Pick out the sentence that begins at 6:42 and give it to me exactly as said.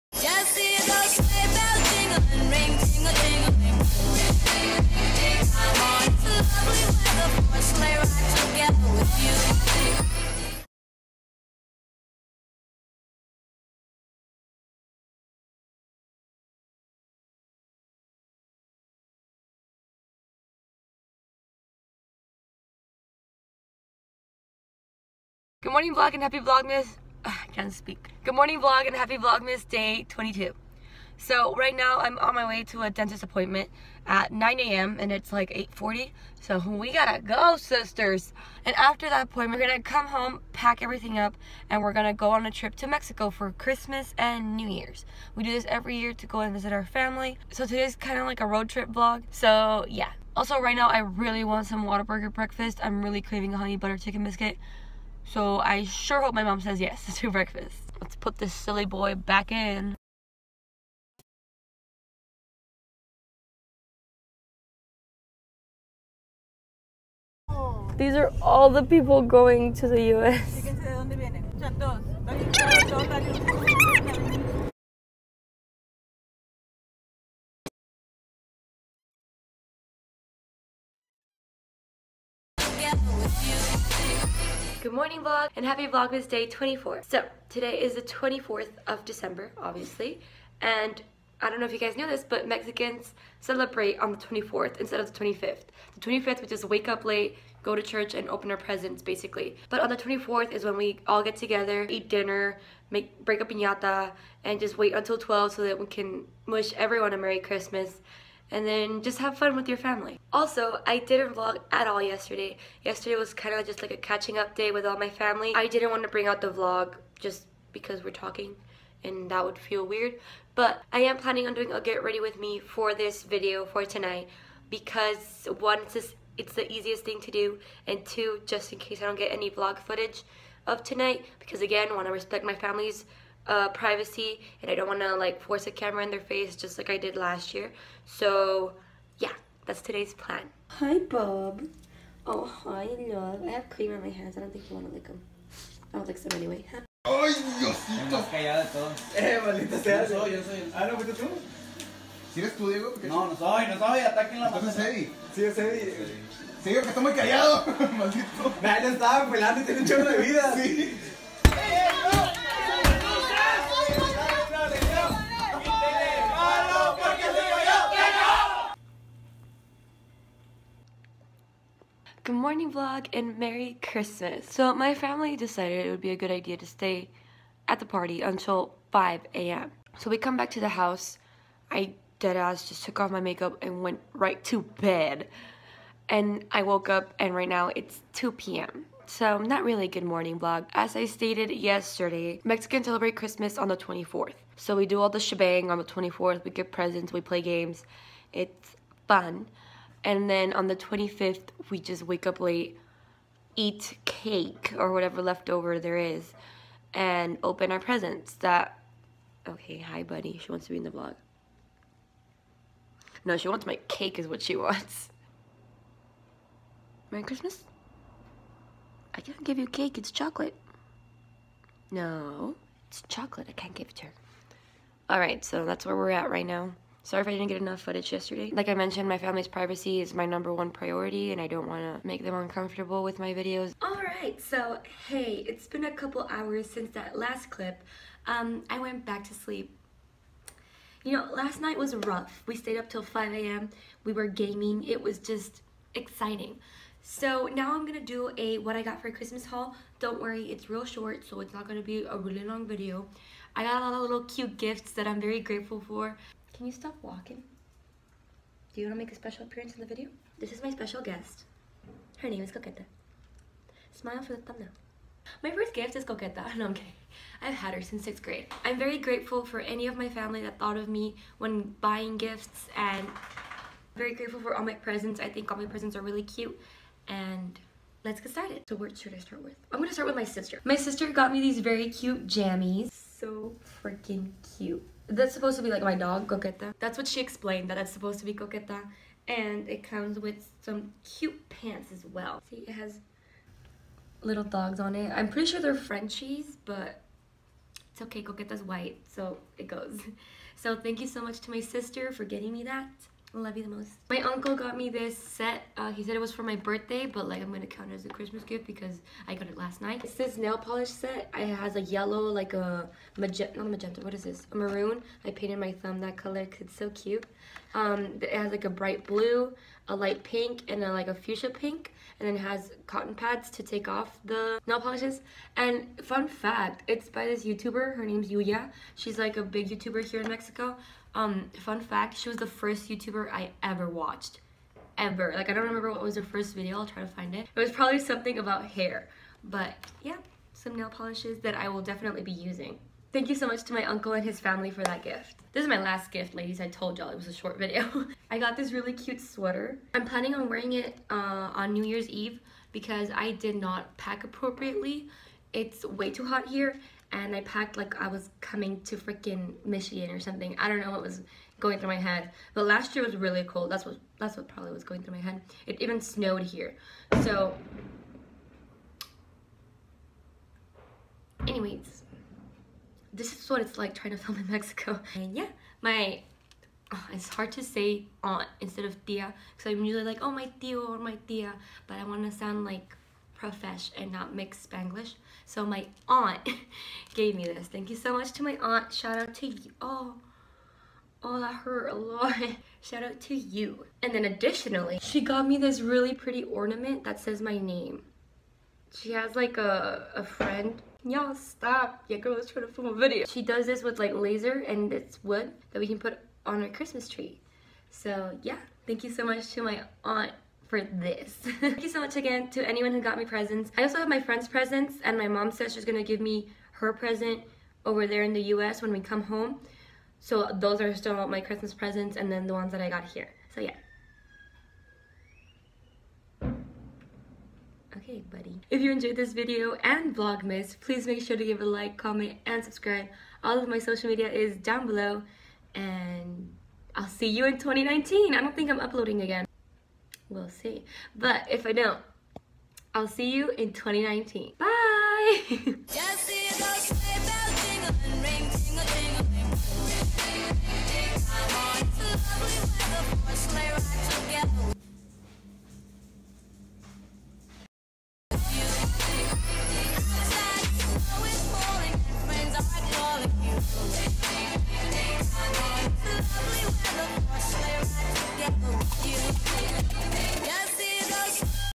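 Yeah, girl let's try to film a video.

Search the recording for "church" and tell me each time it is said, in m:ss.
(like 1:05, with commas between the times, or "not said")
1:37.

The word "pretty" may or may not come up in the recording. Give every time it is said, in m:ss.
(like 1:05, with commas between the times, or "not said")
4:55, 6:36.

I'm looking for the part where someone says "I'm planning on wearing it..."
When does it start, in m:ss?
5:49.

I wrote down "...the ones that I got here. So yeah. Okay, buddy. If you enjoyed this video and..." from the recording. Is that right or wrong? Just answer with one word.
right.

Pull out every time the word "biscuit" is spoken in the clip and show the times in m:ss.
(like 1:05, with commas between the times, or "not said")
0:54.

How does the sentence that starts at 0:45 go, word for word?
We do this every year to go and visit our family.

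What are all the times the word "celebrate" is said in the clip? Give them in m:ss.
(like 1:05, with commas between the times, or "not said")
1:33, 3:12.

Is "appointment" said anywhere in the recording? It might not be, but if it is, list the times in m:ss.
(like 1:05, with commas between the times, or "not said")
0:33, 0:39.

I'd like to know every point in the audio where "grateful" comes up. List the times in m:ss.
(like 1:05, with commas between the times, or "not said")
4:15, 4:28, 4:34.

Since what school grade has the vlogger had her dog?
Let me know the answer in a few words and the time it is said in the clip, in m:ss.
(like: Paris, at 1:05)
6th grade, at 4:28.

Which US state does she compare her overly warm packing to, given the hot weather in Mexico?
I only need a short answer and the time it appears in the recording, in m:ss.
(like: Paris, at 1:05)
Michigan, at 5:59.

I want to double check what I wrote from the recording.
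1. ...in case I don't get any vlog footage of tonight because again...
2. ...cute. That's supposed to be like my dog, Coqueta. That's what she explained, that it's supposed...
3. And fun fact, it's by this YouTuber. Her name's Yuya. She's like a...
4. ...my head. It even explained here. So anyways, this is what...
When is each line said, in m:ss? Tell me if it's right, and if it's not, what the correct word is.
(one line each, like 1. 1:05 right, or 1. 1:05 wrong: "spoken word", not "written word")
1. 2:08 right
2. 4:44 right
3. 5:25 right
4. 6:05 wrong: "snowed", not "explained".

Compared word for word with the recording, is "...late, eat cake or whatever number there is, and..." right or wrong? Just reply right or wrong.
wrong.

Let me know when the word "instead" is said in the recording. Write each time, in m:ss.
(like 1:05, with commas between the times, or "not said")
1:34, 6:18.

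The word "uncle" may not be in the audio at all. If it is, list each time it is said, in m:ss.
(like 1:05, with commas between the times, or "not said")
5:04, 5:43.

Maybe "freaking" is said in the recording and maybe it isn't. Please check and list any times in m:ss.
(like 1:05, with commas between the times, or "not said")
4:43, 5:58.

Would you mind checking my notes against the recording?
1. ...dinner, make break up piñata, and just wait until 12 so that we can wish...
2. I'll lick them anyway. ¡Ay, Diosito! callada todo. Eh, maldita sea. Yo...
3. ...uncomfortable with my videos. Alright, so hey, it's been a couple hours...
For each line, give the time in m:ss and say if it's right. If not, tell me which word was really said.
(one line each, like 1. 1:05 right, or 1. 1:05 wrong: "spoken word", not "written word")
1. 1:42 right
2. 2:25 right
3. 3:52 right.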